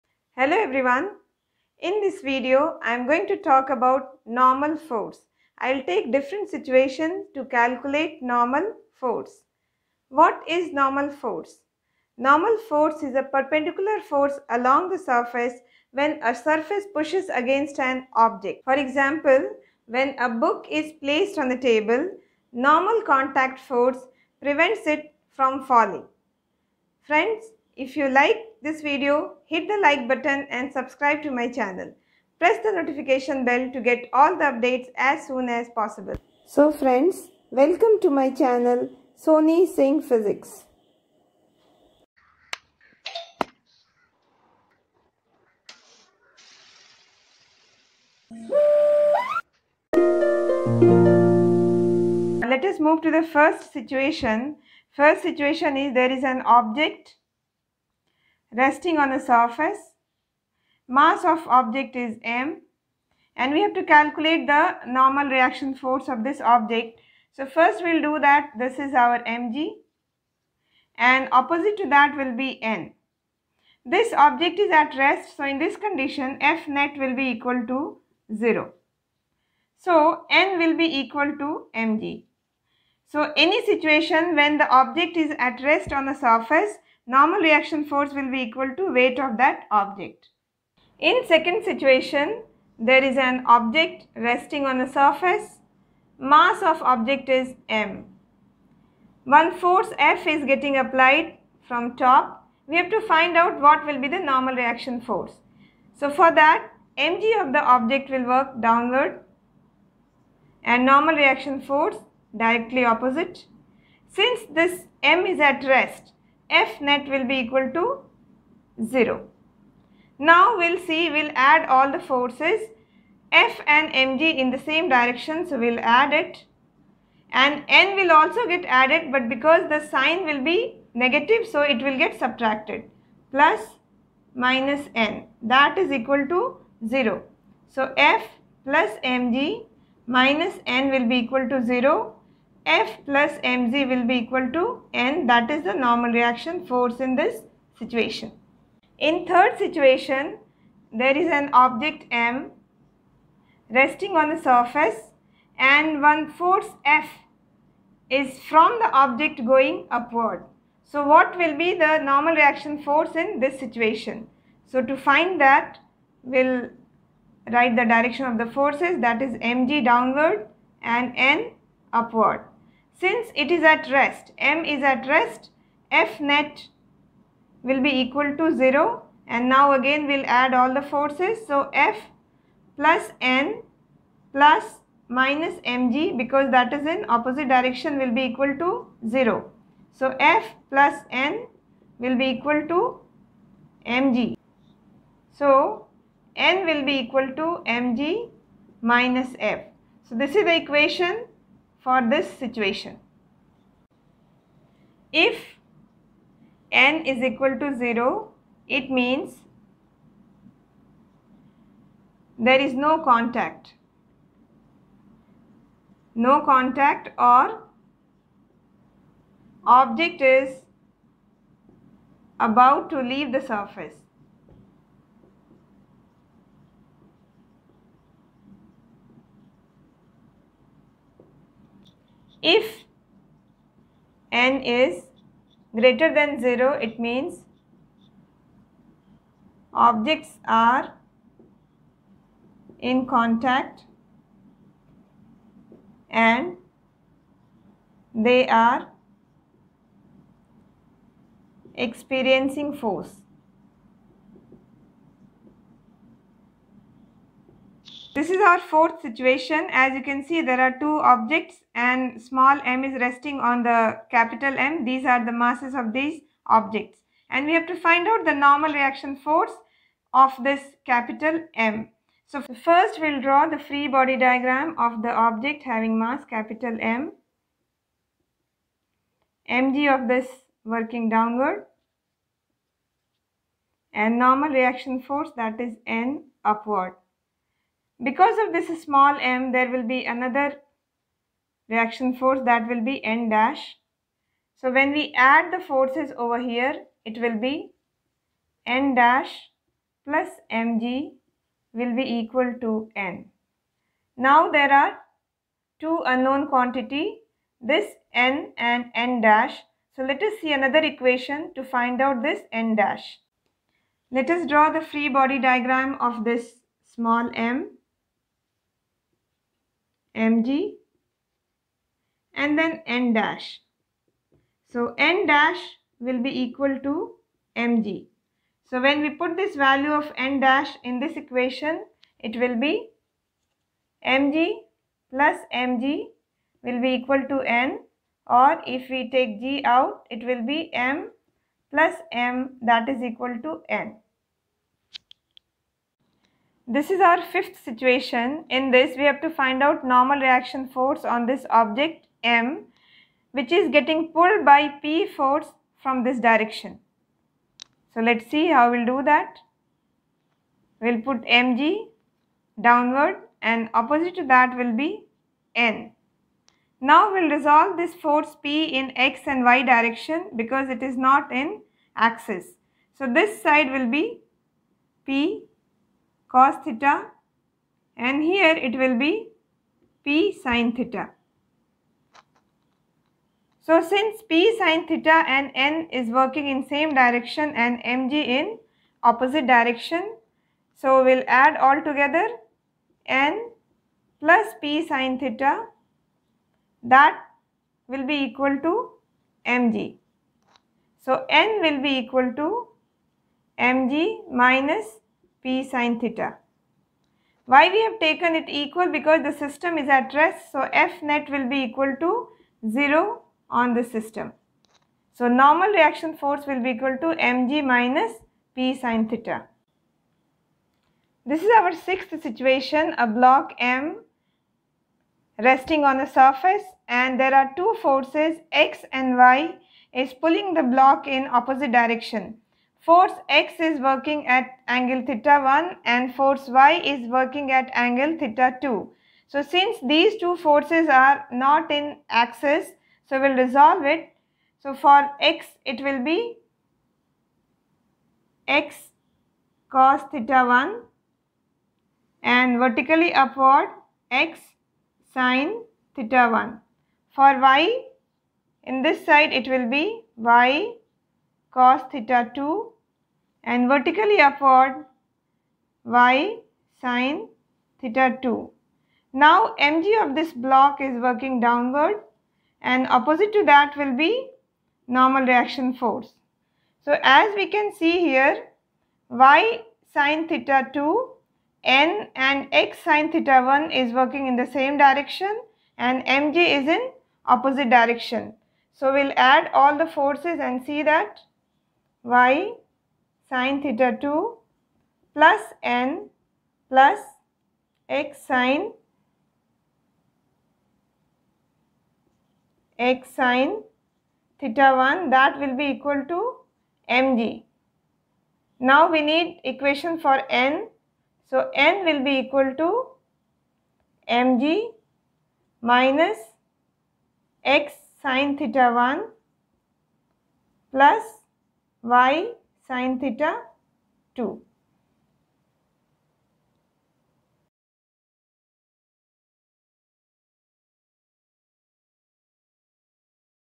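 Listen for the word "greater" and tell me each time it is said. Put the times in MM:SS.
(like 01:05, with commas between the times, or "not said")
03:55.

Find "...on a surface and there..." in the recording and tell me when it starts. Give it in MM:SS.
07:05.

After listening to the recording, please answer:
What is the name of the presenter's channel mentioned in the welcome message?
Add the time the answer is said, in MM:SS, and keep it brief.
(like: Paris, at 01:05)
Soni Singh Physics, at 00:39.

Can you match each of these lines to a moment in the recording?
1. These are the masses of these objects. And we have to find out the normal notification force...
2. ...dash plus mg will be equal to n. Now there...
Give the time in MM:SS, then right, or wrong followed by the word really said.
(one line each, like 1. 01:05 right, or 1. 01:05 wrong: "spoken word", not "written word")
1. 04:24 wrong: "reaction", not "notification"
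2. 04:58 right.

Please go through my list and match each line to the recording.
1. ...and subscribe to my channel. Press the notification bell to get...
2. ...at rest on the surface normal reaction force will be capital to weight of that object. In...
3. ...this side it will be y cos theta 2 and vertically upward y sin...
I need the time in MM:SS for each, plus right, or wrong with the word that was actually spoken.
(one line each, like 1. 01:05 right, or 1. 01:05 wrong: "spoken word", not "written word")
1. 00:30 right
2. 01:25 wrong: "equal", not "capital"
3. 07:38 right.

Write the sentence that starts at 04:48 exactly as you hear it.
Because of this small m, there will be another reaction force that will be n dash.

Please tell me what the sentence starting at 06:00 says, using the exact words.
We'll put mg downward and opposite to that will be n.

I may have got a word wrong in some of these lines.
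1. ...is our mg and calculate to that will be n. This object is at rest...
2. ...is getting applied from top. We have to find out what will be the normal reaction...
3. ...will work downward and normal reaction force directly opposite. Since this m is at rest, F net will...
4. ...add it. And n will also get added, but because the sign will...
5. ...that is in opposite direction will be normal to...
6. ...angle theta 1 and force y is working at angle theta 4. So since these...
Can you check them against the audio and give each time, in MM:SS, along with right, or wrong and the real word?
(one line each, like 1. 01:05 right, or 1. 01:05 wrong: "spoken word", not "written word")
1. 01:08 wrong: "opposite", not "calculate"
2. 01:40 right
3. 01:48 right
4. 02:05 right
5. 03:06 wrong: "equal", not "normal"
6. 07:14 wrong: "2", not "4".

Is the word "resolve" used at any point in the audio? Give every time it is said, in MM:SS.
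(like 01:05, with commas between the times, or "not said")
06:07, 07:23.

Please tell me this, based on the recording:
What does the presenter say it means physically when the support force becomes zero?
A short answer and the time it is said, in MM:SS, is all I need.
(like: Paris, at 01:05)
No contact, at 03:32.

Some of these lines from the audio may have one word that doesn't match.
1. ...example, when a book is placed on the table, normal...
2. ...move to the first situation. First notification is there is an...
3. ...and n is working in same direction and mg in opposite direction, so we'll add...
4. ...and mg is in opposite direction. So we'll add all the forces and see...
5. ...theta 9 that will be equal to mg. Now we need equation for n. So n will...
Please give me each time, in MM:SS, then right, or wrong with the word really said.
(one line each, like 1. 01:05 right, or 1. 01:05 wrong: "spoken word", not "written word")
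1. 00:18 right
2. 00:52 wrong: "situation", not "notification"
3. 06:25 right
4. 08:05 right
5. 08:24 wrong: "1", not "9".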